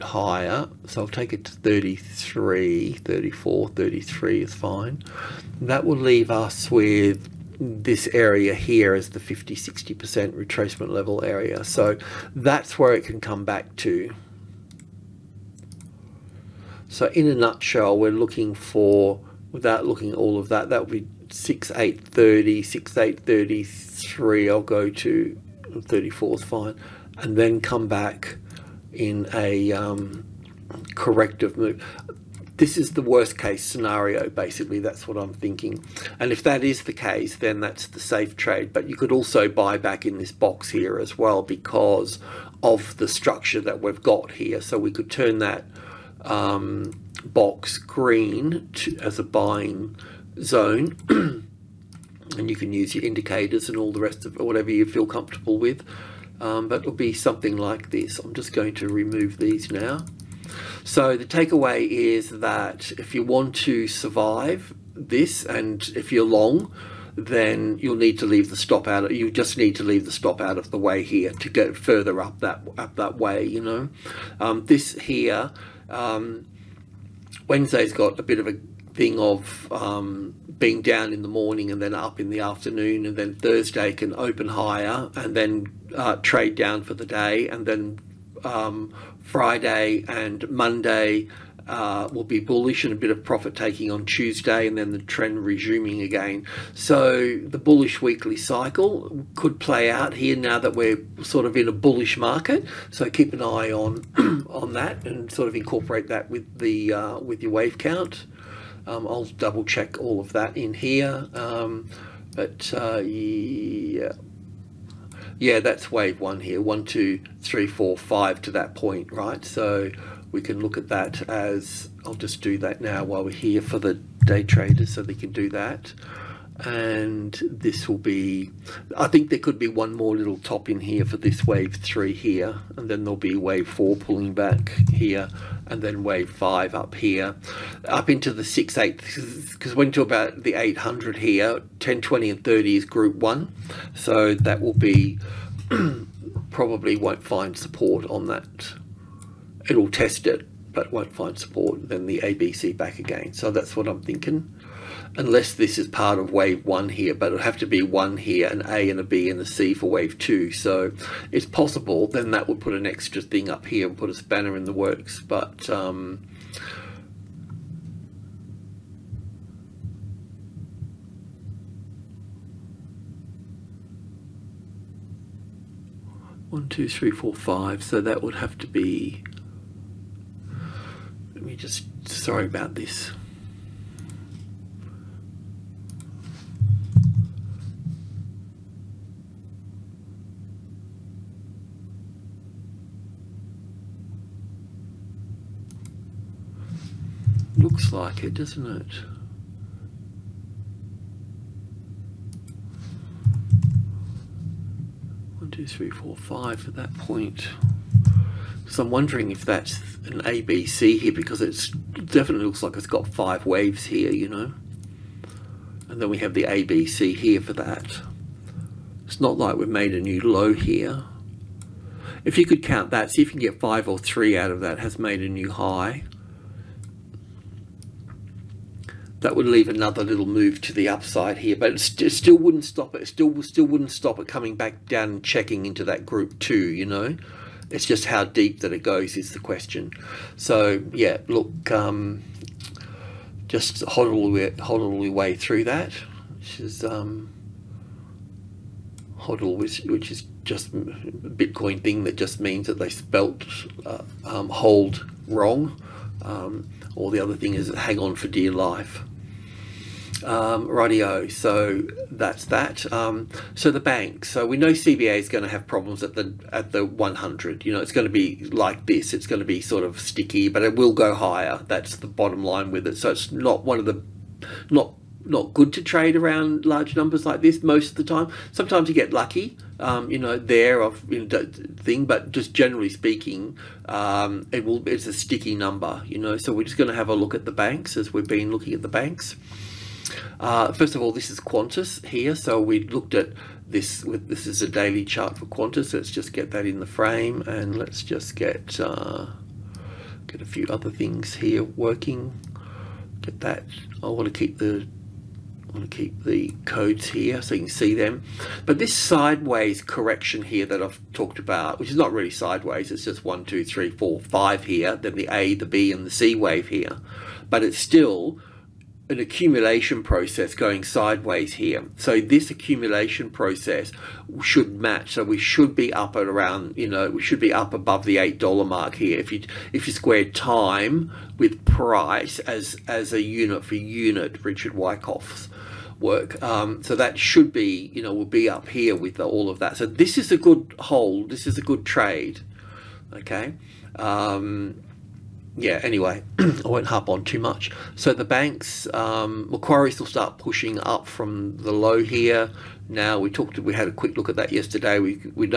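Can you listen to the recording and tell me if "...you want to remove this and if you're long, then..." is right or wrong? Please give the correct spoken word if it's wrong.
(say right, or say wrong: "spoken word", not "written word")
wrong: "survive", not "remove".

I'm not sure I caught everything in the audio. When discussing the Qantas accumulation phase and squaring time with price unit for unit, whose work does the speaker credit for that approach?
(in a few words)
Richard Wyckoff.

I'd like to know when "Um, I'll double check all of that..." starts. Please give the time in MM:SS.
01:48.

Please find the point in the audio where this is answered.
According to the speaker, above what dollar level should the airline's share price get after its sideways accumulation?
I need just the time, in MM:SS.
05:28.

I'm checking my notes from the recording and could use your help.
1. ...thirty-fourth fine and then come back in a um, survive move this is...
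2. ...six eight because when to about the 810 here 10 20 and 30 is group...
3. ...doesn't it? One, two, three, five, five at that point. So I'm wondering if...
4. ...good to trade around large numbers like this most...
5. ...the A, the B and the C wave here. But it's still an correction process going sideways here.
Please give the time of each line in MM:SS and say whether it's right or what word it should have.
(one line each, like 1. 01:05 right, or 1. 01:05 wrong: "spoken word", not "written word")
1. 00:25 wrong: "corrective", not "survive"
2. 02:18 wrong: "800", not "810"
3. 03:18 wrong: "four", not "five"
4. 04:35 right
5. 05:15 wrong: "accumulation", not "correction".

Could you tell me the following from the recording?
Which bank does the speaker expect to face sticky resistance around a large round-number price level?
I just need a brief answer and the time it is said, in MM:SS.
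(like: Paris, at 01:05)
CBA, at 04:24.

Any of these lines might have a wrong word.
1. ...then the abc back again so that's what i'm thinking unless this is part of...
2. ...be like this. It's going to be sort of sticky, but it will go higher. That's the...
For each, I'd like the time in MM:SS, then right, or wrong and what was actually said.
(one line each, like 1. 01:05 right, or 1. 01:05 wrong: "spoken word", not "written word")
1. 02:31 right
2. 04:28 right.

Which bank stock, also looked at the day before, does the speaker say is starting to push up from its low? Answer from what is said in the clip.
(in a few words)
Macquarie.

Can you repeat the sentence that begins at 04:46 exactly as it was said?
So we're just going to have a look at the banks as we've been looking at the banks.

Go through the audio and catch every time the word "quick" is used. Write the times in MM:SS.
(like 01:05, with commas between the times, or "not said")
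05:53.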